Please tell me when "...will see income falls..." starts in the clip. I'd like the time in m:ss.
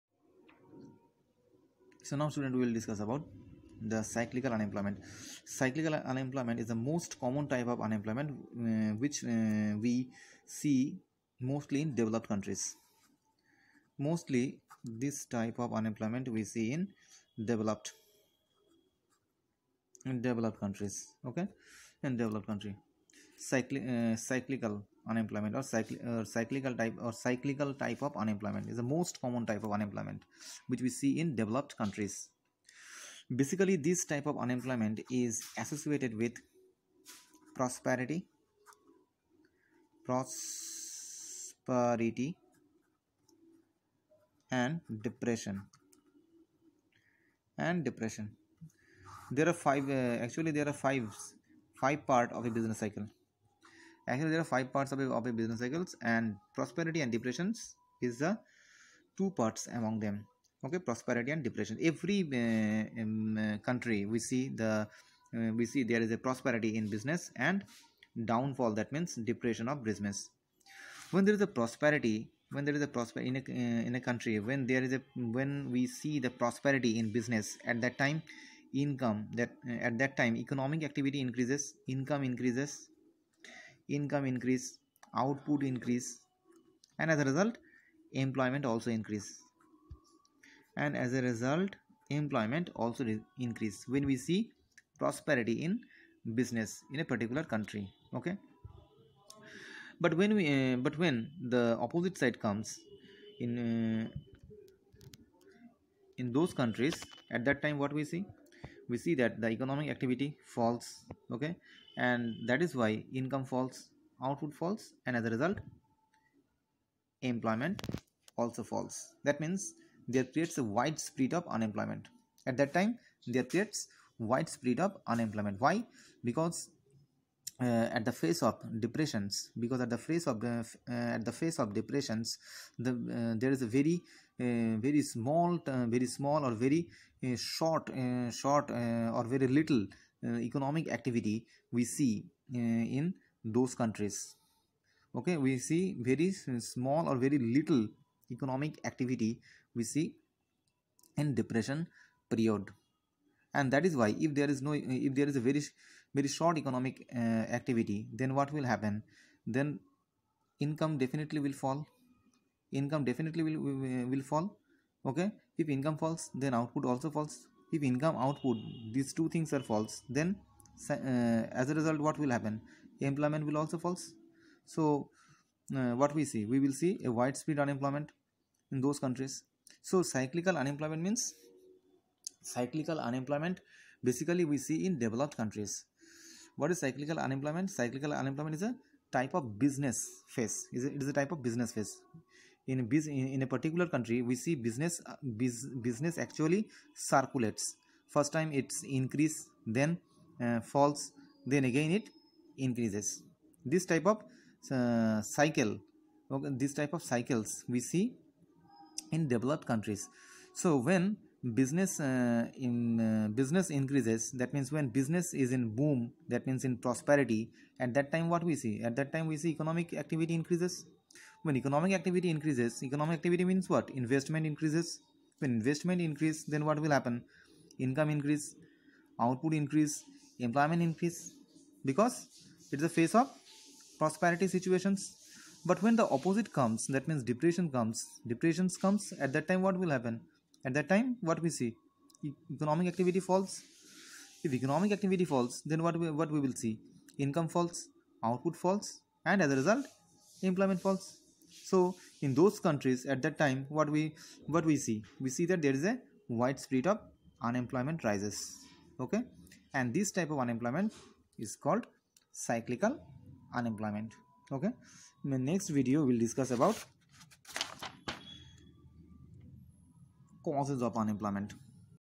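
4:06.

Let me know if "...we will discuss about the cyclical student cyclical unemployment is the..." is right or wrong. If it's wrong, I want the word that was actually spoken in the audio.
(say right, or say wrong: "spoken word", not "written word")
wrong: "unemployment", not "student".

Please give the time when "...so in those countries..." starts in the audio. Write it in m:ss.
4:11.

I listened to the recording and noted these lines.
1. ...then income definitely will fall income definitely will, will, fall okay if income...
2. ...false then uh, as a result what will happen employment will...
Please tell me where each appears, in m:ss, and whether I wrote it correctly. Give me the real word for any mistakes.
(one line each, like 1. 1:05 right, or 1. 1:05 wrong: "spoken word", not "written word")
1. 2:39 right
2. 2:49 right.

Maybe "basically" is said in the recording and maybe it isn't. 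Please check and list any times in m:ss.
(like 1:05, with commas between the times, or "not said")
0:33, 3:04.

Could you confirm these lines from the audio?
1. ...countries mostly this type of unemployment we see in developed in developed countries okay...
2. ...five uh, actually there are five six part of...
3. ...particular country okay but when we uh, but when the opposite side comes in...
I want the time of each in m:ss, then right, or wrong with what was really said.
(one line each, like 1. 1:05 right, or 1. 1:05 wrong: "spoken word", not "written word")
1. 0:12 right
2. 0:49 wrong: "five", not "six"
3. 1:37 right.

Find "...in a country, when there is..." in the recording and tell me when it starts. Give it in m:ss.
1:13.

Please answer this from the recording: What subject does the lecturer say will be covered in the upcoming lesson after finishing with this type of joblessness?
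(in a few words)
Causes of unemployment.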